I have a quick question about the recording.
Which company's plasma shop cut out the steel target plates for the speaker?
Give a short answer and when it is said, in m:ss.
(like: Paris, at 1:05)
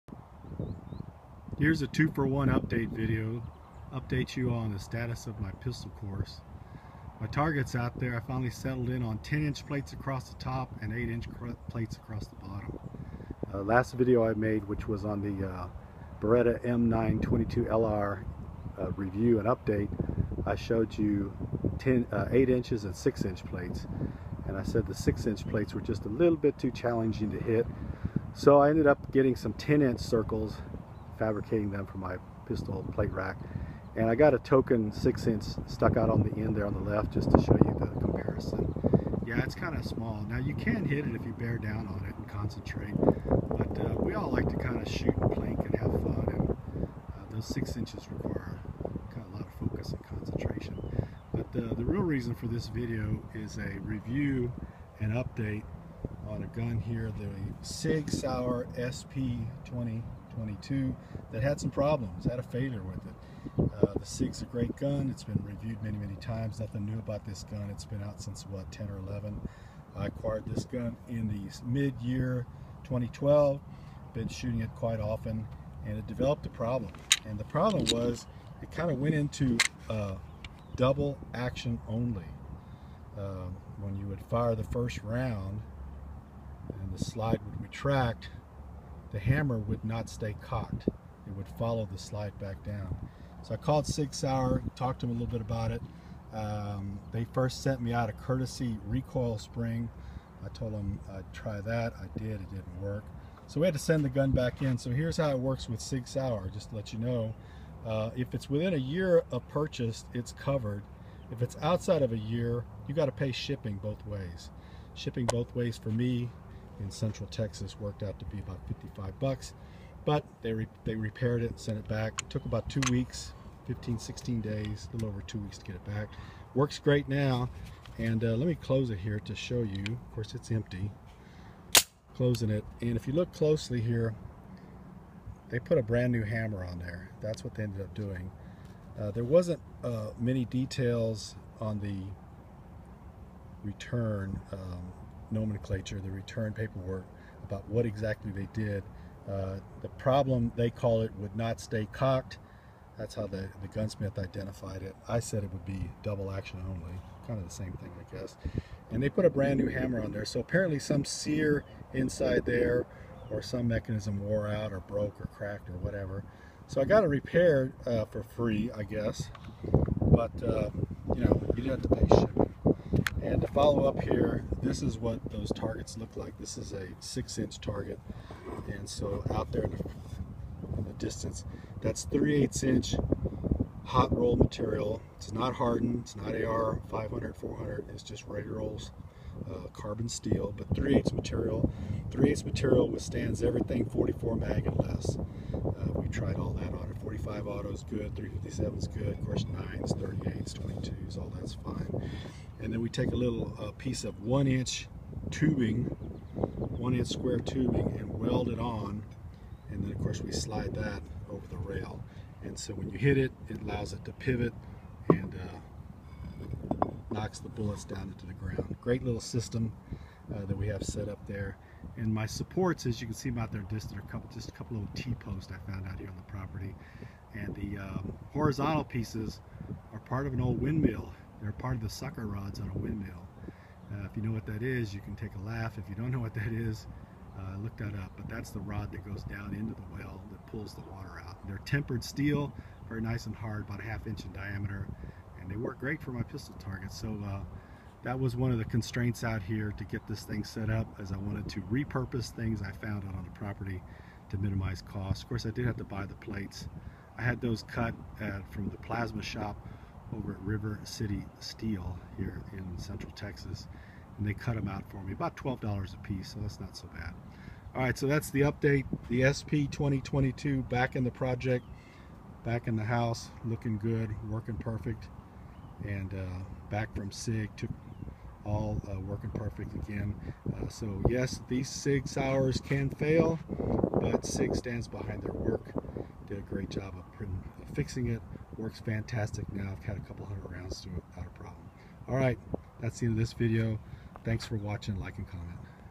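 River City Steel, at 4:20.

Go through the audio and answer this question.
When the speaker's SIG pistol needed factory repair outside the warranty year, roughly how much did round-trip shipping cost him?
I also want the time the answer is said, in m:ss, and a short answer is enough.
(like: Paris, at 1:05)
$55, at 1:58.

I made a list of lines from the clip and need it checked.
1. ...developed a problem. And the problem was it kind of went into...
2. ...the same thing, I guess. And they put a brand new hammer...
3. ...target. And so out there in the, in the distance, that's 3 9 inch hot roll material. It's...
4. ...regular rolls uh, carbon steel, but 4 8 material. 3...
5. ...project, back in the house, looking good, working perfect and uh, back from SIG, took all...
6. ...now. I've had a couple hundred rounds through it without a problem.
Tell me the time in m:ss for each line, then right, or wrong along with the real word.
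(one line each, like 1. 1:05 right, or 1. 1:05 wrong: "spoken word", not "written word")
1. 1:16 right
2. 2:37 right
3. 2:57 wrong: "8", not "9"
4. 3:08 wrong: "3", not "4"
5. 4:31 right
6. 4:49 right.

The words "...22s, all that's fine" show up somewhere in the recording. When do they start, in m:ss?
3:20.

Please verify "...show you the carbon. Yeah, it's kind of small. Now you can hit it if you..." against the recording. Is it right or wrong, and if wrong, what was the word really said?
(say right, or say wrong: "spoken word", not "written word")
wrong: "comparison", not "carbon".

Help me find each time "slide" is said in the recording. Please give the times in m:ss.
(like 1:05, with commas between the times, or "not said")
1:27, 1:31, 3:30.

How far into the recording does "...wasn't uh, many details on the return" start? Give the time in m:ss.
2:19.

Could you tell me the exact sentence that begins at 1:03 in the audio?
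Uh, the SIG's a great gun.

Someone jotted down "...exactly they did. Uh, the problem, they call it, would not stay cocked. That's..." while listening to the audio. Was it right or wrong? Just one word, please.
right.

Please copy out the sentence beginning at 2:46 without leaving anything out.
So I got it repaired uh, for free, I guess.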